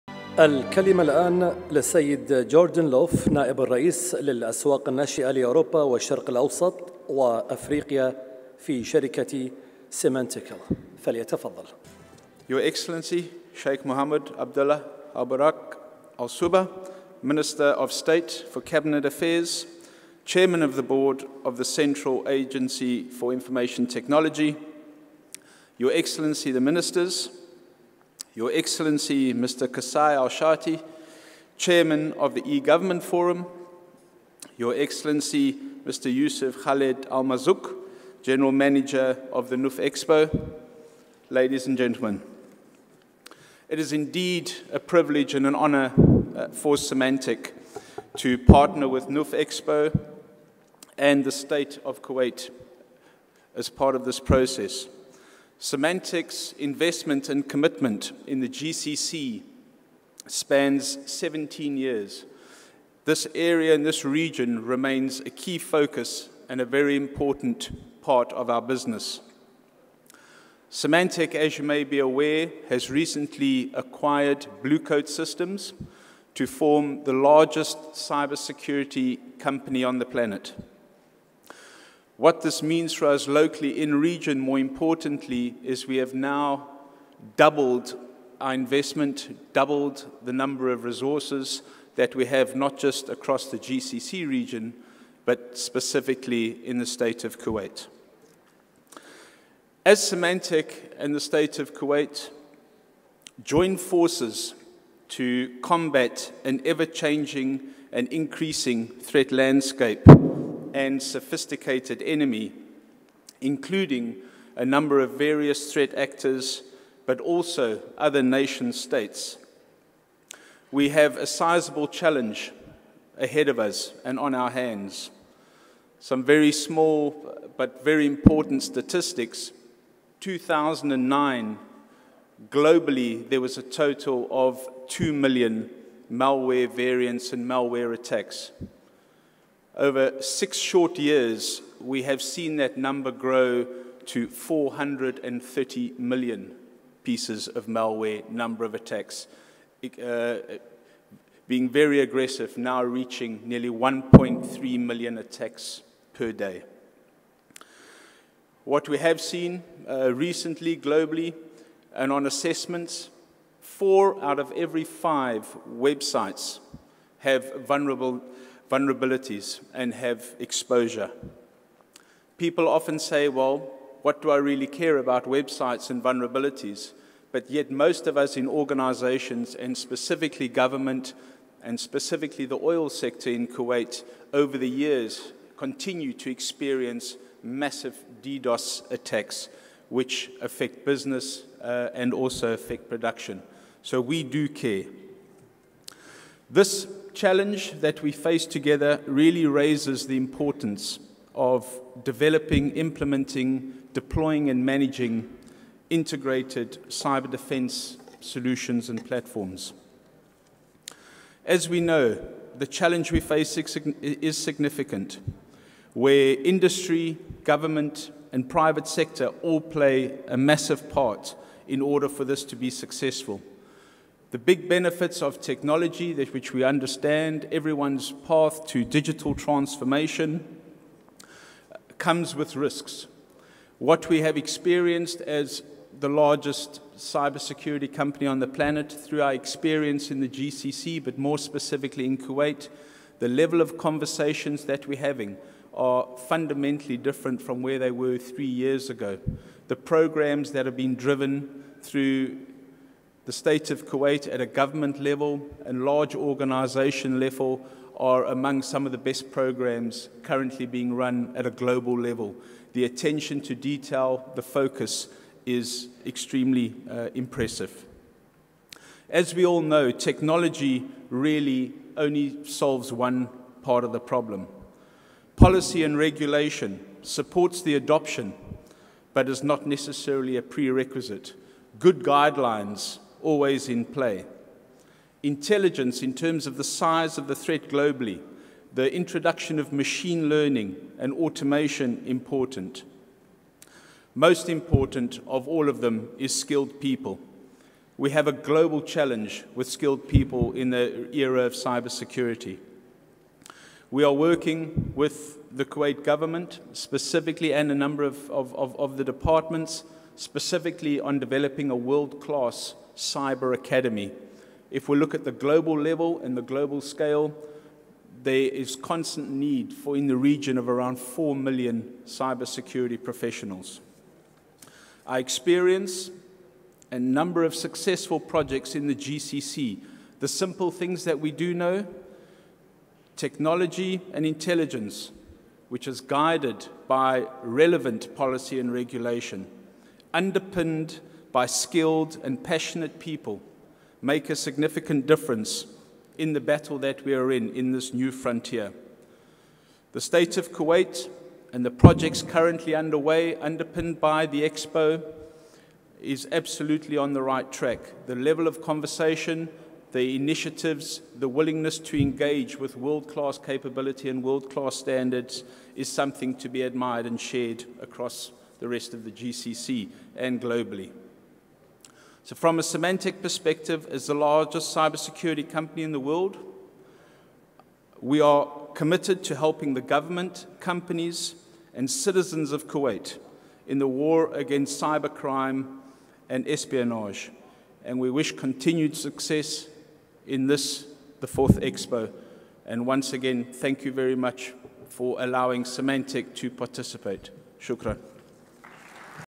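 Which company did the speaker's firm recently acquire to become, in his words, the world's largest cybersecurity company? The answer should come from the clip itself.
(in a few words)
Blue Coat Systems.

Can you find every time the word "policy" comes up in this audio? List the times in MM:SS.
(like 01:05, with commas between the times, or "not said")
04:35, 05:38.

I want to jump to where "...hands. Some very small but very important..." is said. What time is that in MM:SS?
02:04.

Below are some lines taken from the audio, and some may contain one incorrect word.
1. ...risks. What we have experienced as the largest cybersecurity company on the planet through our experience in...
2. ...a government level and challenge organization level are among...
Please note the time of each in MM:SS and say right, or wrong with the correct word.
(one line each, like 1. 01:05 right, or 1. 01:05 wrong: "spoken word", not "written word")
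1. 03:52 right
2. 04:14 wrong: "large", not "challenge".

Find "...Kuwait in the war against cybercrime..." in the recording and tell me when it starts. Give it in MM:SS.
06:22.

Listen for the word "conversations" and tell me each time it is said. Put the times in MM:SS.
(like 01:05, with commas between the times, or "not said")
04:03, 05:58.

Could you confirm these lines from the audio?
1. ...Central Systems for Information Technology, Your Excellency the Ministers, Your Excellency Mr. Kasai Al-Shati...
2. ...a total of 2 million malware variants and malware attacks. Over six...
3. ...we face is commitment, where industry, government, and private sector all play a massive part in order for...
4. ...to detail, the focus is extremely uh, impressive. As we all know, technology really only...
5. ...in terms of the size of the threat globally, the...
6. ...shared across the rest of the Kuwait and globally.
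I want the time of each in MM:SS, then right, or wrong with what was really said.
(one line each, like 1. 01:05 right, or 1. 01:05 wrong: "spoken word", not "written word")
1. 00:21 wrong: "Agency", not "Systems"
2. 02:13 right
3. 03:33 wrong: "significant", not "commitment"
4. 04:23 right
5. 04:46 right
6. 06:07 wrong: "GCC", not "Kuwait".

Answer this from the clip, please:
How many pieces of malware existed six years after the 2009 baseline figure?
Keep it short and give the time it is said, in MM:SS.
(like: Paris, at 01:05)
430 million, at 02:24.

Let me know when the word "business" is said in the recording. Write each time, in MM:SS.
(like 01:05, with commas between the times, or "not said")
01:08, 03:10.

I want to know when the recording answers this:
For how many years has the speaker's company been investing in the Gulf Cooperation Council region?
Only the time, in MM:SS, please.
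01:01.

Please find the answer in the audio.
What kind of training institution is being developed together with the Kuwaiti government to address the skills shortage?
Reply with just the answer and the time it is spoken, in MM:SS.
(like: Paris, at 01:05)
cyber academy, at 05:12.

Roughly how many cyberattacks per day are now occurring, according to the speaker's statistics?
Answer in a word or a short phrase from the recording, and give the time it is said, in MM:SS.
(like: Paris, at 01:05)
1.3 million, at 02:33.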